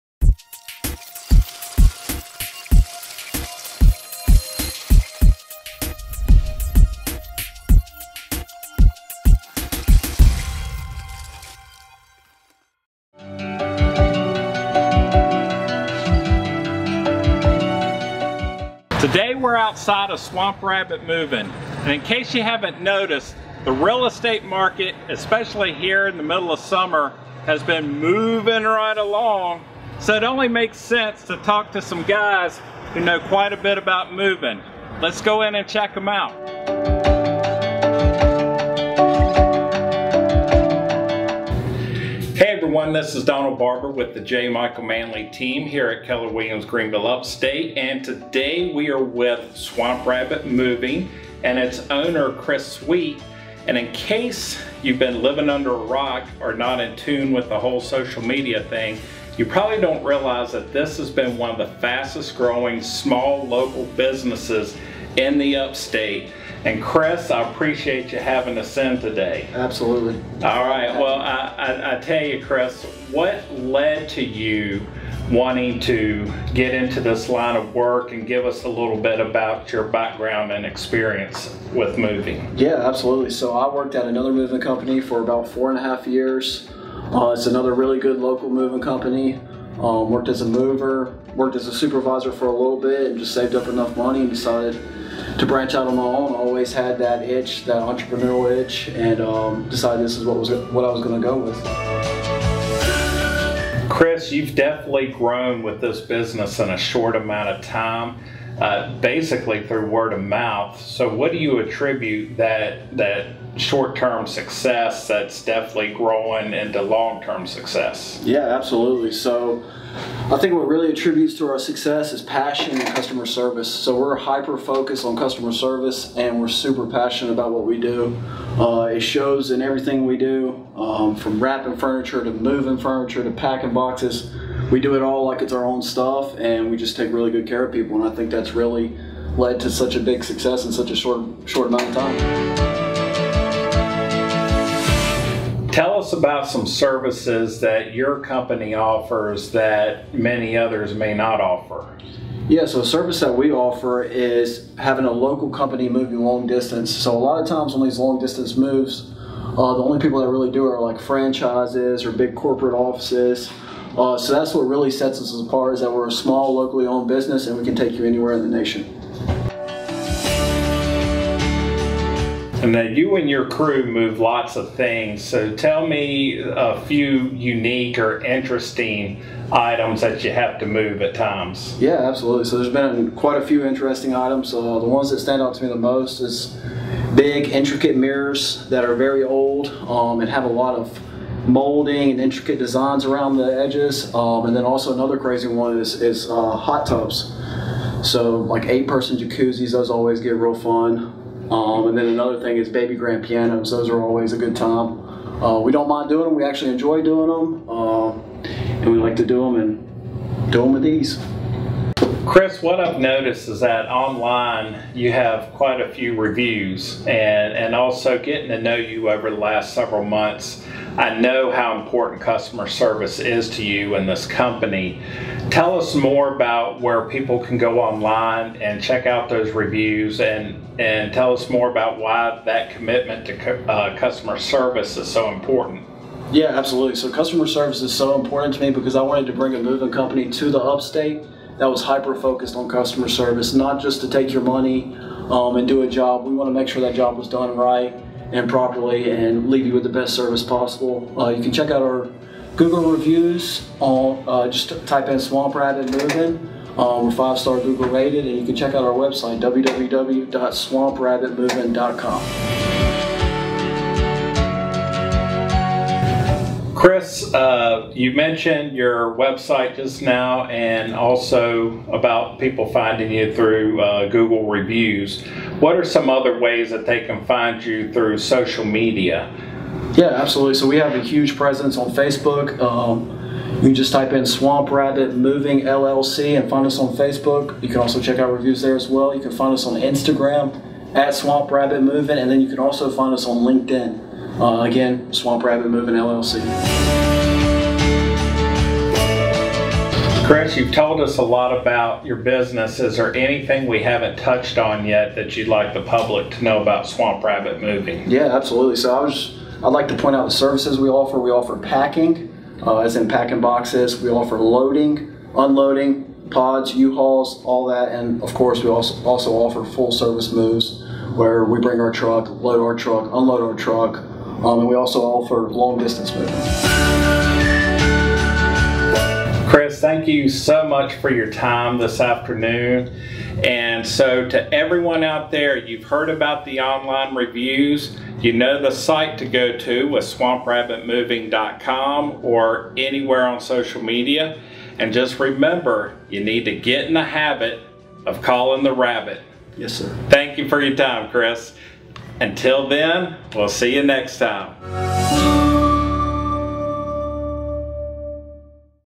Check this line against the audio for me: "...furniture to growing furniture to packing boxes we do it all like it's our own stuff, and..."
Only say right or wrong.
wrong.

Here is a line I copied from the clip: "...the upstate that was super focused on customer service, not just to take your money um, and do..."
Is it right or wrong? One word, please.
wrong.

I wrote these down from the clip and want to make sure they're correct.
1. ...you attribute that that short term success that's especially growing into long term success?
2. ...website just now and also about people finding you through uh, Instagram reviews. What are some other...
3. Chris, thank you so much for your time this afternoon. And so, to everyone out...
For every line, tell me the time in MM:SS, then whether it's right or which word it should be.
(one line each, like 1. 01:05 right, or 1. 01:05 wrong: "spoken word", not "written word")
1. 01:51 wrong: "definitely", not "especially"
2. 04:29 wrong: "Google", not "Instagram"
3. 05:29 right.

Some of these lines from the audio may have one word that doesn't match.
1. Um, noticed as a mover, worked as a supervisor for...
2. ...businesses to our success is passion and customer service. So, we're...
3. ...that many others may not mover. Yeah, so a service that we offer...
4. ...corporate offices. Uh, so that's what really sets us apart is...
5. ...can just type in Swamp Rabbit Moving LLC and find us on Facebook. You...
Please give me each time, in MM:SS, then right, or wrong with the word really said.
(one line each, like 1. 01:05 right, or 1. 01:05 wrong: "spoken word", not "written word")
1. 01:29 wrong: "worked", not "noticed"
2. 02:00 wrong: "attributes", not "businesses"
3. 02:29 wrong: "offer", not "mover"
4. 02:42 right
5. 04:43 right.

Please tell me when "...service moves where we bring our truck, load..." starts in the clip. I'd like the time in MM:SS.
05:19.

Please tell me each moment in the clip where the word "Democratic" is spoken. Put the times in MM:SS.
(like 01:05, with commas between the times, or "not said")
not said.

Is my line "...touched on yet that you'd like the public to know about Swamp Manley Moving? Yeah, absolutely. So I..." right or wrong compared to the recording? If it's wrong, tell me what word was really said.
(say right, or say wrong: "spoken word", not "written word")
wrong: "Rabbit", not "Manley".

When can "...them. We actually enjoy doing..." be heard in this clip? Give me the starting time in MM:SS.
03:26.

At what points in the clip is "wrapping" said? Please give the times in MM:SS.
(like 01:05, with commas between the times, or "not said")
02:11.